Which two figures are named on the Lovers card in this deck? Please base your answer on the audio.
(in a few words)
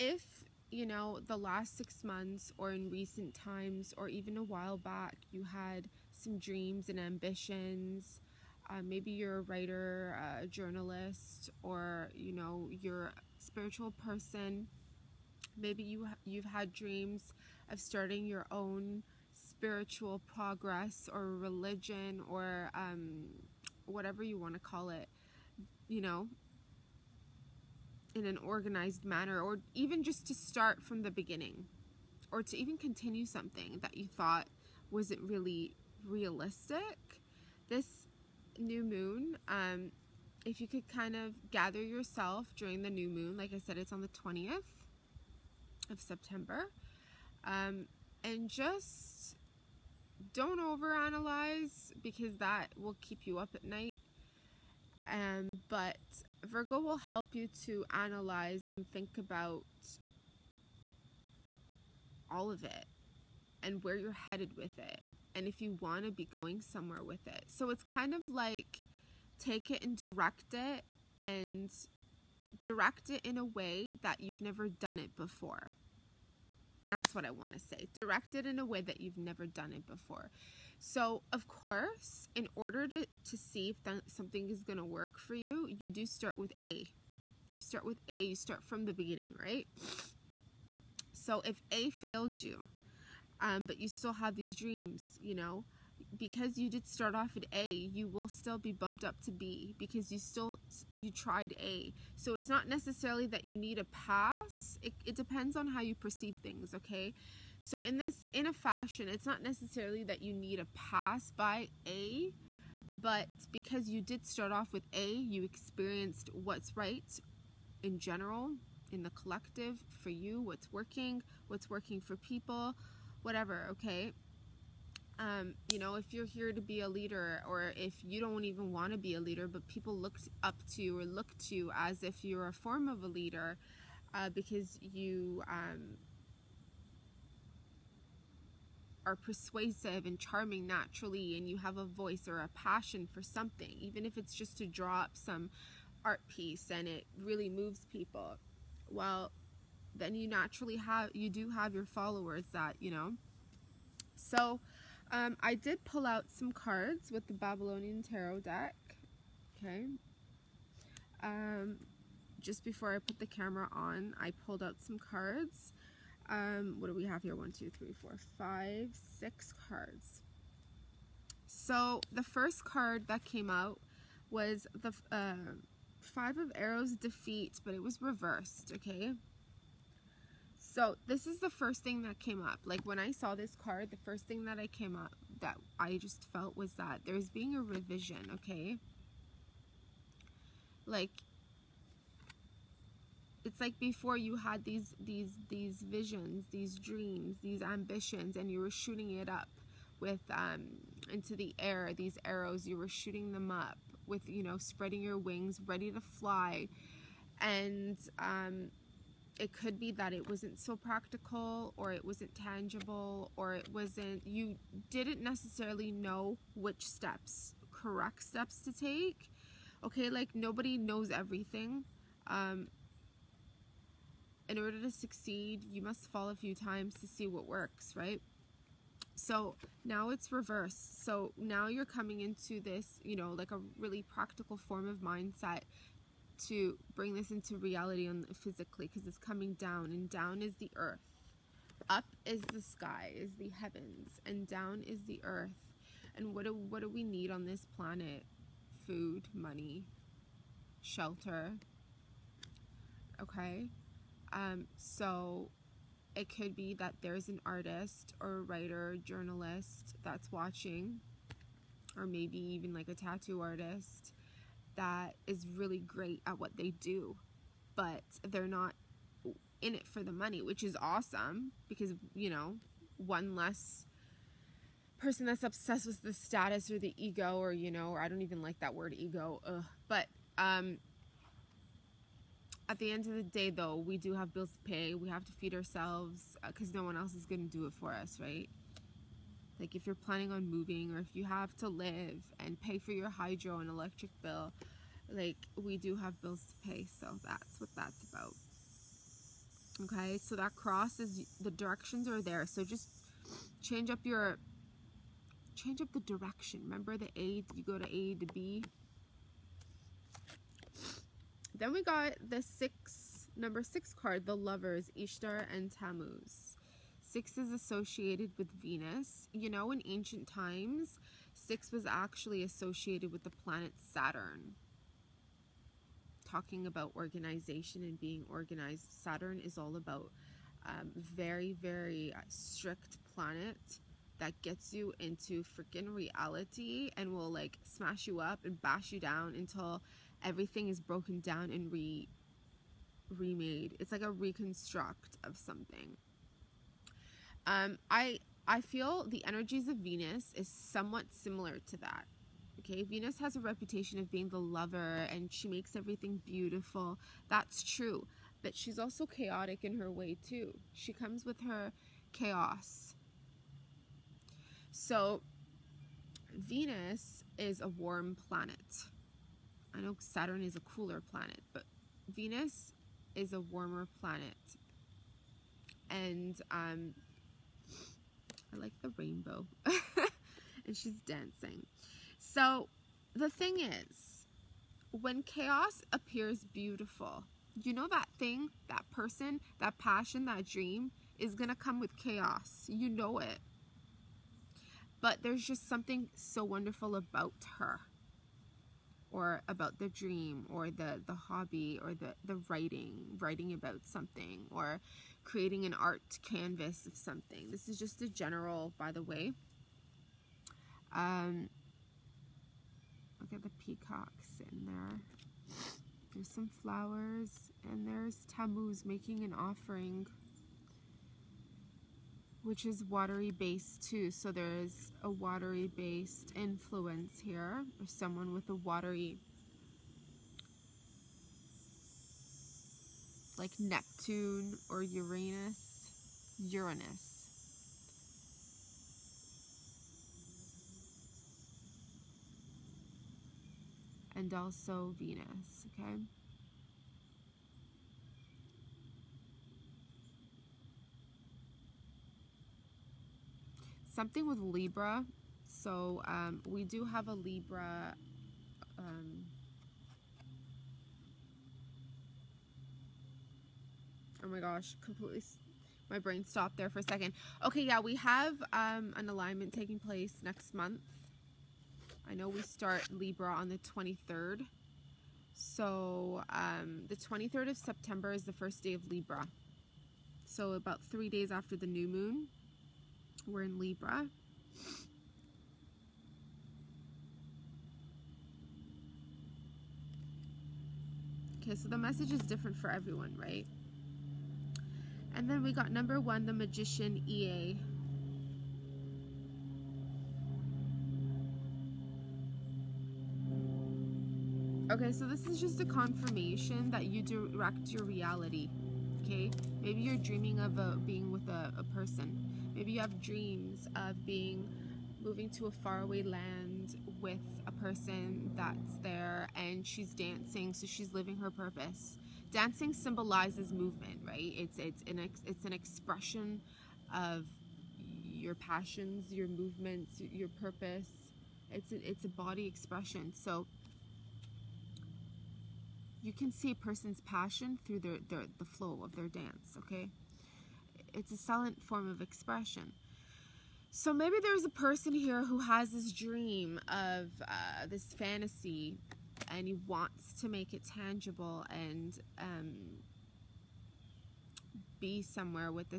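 Ishtar and Tammuz.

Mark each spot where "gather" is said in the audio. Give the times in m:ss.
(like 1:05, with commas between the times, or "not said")
0:41.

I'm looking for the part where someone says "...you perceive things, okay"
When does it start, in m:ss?
1:45.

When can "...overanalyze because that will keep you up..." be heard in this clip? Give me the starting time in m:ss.
0:50.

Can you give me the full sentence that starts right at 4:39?
But um, at the end of the day, though, we do have bills to pay.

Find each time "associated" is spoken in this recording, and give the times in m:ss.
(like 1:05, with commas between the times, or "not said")
5:17, 5:22.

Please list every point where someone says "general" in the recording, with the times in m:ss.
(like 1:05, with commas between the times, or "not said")
1:57, 6:48.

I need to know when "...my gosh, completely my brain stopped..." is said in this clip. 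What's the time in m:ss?
7:44.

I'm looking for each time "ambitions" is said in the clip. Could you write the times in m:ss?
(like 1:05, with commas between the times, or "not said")
0:06, 3:17.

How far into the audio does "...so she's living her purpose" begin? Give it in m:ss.
8:40.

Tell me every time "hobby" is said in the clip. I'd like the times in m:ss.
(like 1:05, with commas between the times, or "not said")
6:41.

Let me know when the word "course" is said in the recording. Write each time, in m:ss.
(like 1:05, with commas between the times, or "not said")
1:21.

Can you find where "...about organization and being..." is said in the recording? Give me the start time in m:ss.
5:26.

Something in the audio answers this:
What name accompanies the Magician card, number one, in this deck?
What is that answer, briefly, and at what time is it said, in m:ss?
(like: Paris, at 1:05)
EA, at 8:17.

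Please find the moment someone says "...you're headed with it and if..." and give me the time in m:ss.
1:03.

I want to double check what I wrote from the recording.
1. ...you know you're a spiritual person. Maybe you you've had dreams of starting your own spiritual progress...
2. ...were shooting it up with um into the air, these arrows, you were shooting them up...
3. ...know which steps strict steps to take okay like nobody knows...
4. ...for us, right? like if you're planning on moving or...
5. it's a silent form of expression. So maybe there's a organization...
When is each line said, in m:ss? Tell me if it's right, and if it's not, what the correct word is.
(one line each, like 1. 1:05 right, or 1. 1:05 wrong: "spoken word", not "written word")
1. 0:12 right
2. 3:18 right
3. 3:35 wrong: "correct", not "strict"
4. 4:47 right
5. 9:00 wrong: "person", not "organization".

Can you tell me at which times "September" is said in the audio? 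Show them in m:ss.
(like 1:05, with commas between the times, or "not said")
0:45, 7:57.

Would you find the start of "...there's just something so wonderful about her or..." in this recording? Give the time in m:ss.
6:35.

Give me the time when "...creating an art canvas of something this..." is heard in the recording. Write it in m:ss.
6:45.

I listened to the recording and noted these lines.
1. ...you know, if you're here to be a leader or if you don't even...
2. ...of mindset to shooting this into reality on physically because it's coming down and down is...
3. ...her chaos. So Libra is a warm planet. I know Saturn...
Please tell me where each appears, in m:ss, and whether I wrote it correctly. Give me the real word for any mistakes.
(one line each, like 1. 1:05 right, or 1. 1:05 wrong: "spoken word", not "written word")
1. 2:05 right
2. 3:54 wrong: "bring", not "shooting"
3. 6:01 wrong: "Venus", not "Libra".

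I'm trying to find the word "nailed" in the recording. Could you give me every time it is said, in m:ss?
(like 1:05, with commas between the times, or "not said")
not said.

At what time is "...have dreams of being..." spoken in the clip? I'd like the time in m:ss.
8:32.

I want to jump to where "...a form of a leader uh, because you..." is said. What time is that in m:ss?
2:12.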